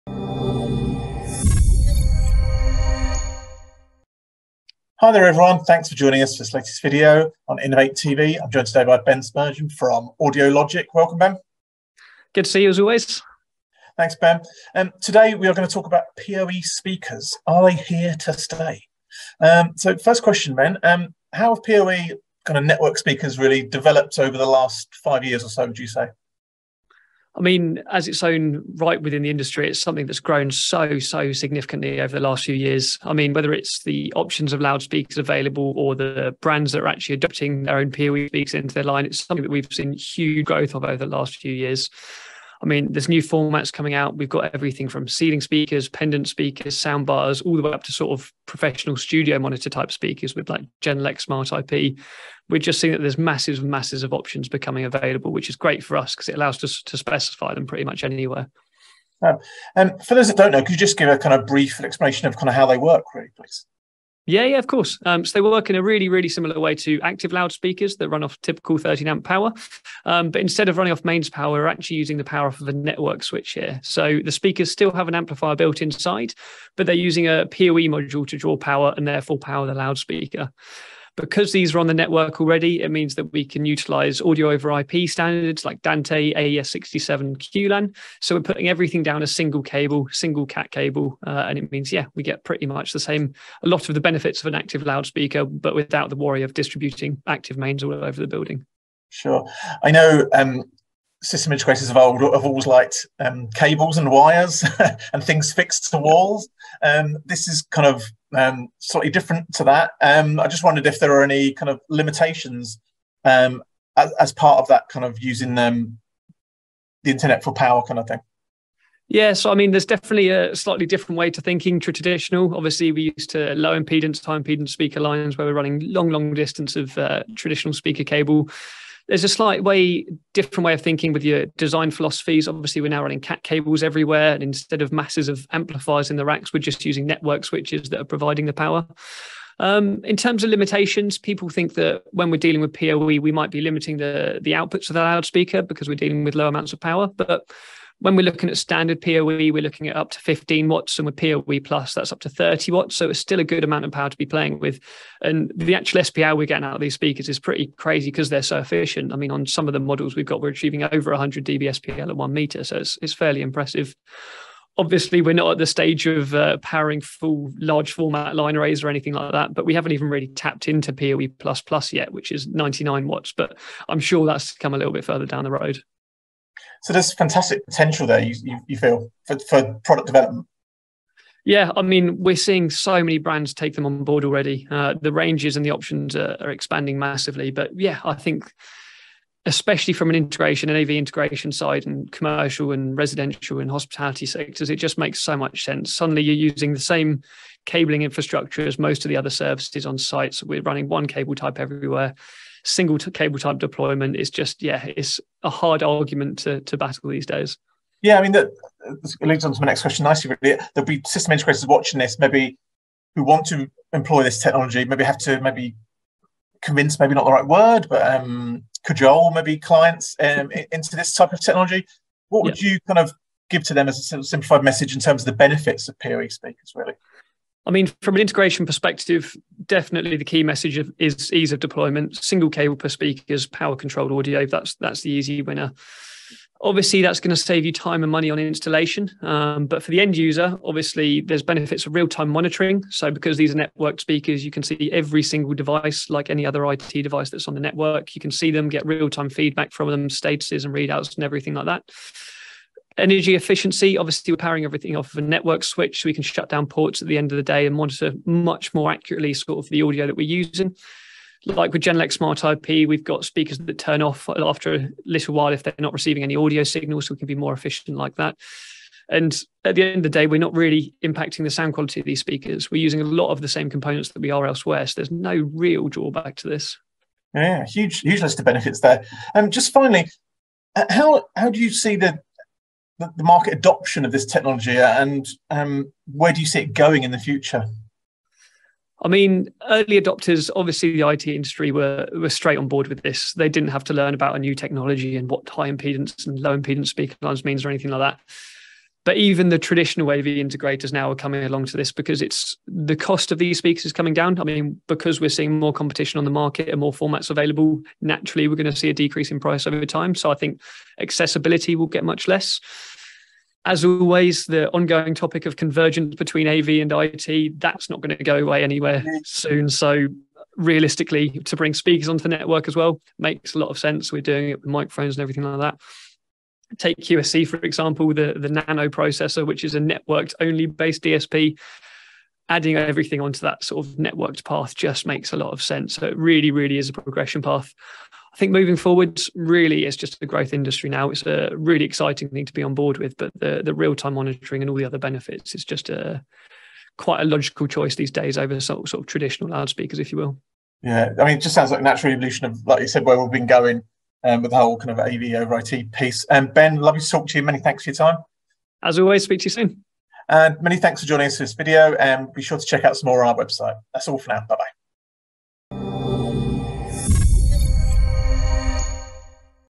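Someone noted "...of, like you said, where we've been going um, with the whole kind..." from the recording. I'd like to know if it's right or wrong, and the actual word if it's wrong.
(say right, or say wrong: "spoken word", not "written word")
right.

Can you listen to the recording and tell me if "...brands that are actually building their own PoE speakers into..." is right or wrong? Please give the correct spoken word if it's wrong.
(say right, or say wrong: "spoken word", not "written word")
wrong: "adopting", not "building".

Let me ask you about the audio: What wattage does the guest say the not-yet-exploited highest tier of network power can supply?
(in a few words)
99 watts.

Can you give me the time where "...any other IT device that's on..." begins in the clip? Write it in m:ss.
4:06.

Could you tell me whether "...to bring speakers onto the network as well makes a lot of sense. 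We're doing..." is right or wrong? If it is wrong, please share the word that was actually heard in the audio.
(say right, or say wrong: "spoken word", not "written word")
right.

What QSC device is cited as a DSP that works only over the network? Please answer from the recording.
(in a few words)
nano processor.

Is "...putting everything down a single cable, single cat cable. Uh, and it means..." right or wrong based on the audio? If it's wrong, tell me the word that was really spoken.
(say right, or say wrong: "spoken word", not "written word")
right.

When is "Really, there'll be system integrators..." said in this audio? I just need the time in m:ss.
3:30.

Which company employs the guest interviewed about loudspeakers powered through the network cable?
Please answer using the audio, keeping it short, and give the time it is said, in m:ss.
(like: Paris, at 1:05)
AudioLogic, at 0:10.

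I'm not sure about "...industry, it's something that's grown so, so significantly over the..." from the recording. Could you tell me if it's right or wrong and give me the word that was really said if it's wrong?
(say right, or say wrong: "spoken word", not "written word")
right.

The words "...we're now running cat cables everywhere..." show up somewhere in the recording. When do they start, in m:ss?
2:12.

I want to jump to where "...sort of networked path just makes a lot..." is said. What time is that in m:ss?
5:33.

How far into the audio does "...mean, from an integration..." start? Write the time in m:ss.
3:47.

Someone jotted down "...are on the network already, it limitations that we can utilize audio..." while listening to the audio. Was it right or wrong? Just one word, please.
wrong.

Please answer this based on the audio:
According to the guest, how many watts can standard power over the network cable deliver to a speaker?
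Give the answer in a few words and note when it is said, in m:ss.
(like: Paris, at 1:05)
15 watts, at 2:30.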